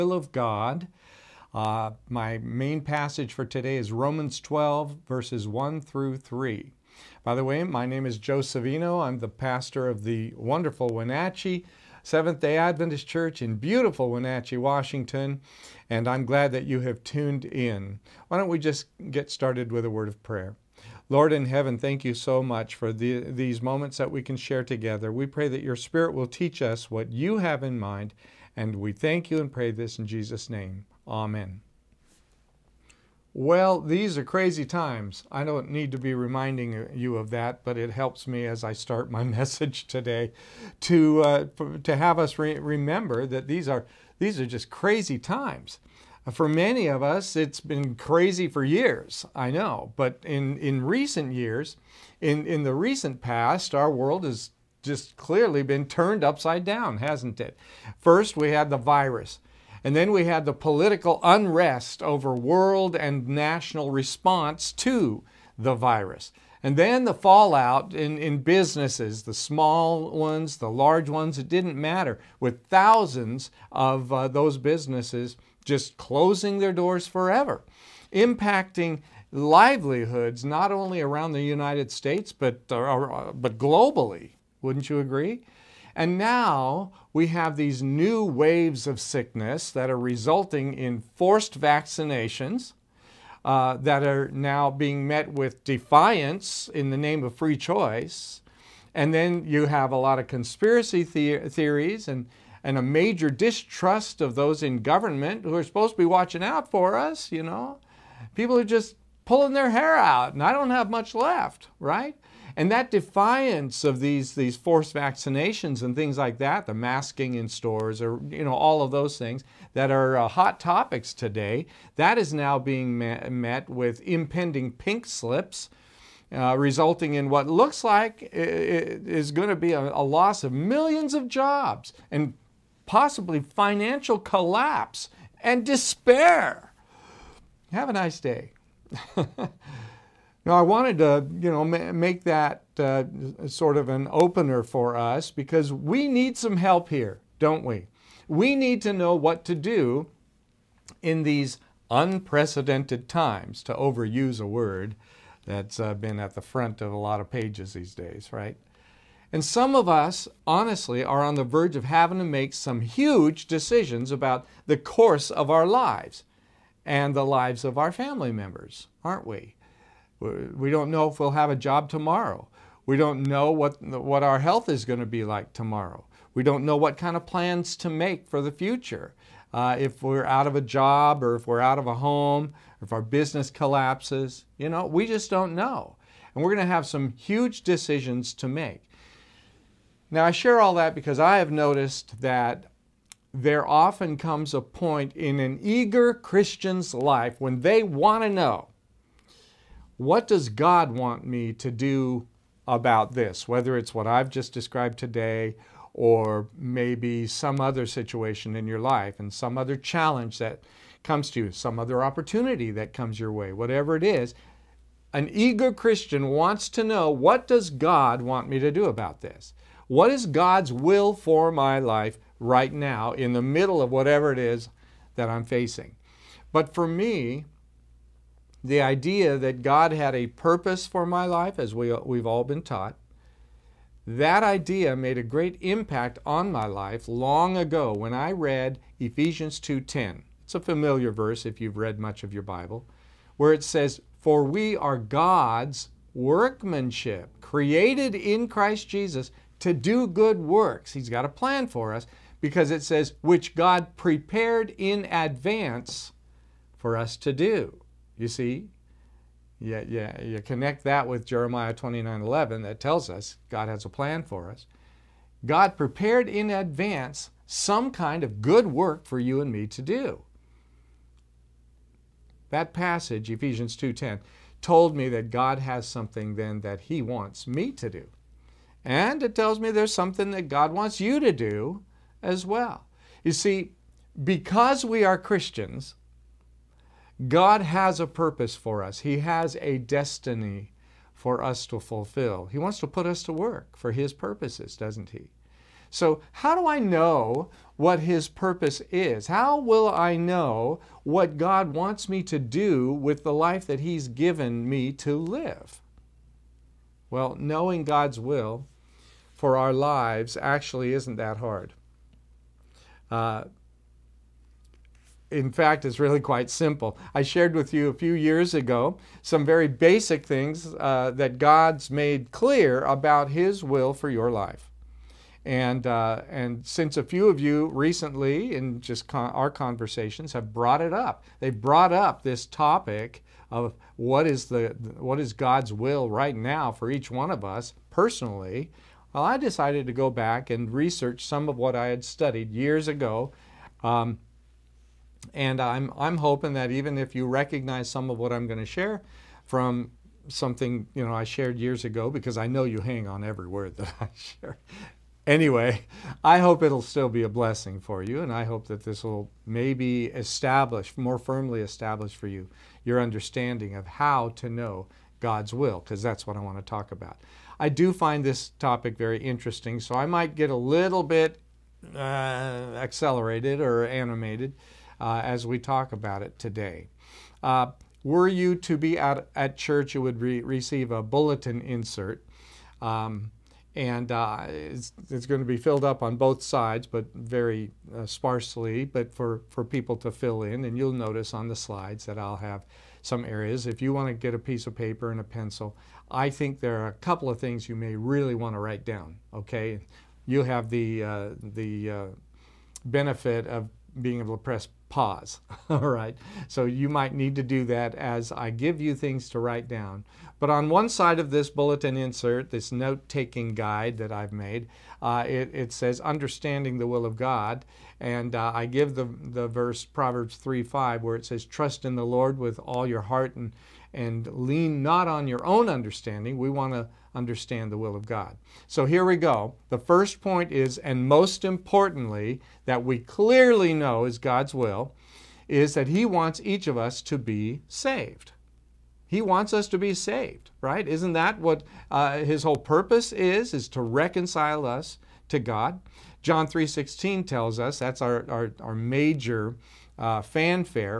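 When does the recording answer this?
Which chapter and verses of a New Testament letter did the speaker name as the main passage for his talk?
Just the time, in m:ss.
0:03.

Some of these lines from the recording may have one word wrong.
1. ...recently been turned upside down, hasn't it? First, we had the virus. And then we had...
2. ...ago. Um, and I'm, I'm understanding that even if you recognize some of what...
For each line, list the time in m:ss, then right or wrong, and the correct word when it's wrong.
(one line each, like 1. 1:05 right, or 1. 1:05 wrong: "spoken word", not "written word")
1. 0:55 wrong: "clearly", not "recently"
2. 5:42 wrong: "hoping", not "understanding".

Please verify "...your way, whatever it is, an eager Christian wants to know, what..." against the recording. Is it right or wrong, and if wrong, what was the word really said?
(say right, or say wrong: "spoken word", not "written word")
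right.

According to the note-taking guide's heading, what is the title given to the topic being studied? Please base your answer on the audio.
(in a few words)
Understanding the will of God.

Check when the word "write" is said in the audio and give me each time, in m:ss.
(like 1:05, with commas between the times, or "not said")
6:38, 6:49.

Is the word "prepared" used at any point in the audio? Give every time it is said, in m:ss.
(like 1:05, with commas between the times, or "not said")
4:13, 4:25.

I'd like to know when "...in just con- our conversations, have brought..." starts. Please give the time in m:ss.
5:28.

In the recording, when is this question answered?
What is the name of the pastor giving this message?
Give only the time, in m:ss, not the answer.
0:08.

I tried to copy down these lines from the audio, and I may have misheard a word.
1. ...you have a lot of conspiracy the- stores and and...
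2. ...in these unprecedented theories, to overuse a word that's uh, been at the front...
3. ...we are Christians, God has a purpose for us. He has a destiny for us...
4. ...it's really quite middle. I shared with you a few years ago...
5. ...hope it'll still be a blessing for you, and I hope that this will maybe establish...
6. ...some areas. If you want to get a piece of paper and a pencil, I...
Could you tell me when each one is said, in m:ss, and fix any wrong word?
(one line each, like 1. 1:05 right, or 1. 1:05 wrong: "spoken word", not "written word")
1. 1:39 wrong: "theories", not "stores"
2. 2:31 wrong: "times", not "theories"
3. 4:44 right
4. 5:15 wrong: "simple", not "middle"
5. 5:56 right
6. 6:33 right.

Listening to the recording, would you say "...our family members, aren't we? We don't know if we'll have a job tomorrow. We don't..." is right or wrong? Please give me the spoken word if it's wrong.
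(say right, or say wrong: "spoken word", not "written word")
right.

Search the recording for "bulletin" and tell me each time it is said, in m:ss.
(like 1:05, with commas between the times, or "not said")
6:21, 6:51.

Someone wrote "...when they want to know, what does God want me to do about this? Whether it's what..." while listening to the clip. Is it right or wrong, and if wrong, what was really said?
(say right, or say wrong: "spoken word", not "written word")
right.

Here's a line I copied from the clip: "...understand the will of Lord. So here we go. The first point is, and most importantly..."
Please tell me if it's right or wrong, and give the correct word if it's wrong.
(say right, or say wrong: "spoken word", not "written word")
wrong: "God", not "Lord".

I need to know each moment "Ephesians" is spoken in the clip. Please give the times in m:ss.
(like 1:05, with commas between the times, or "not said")
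3:58, 4:33.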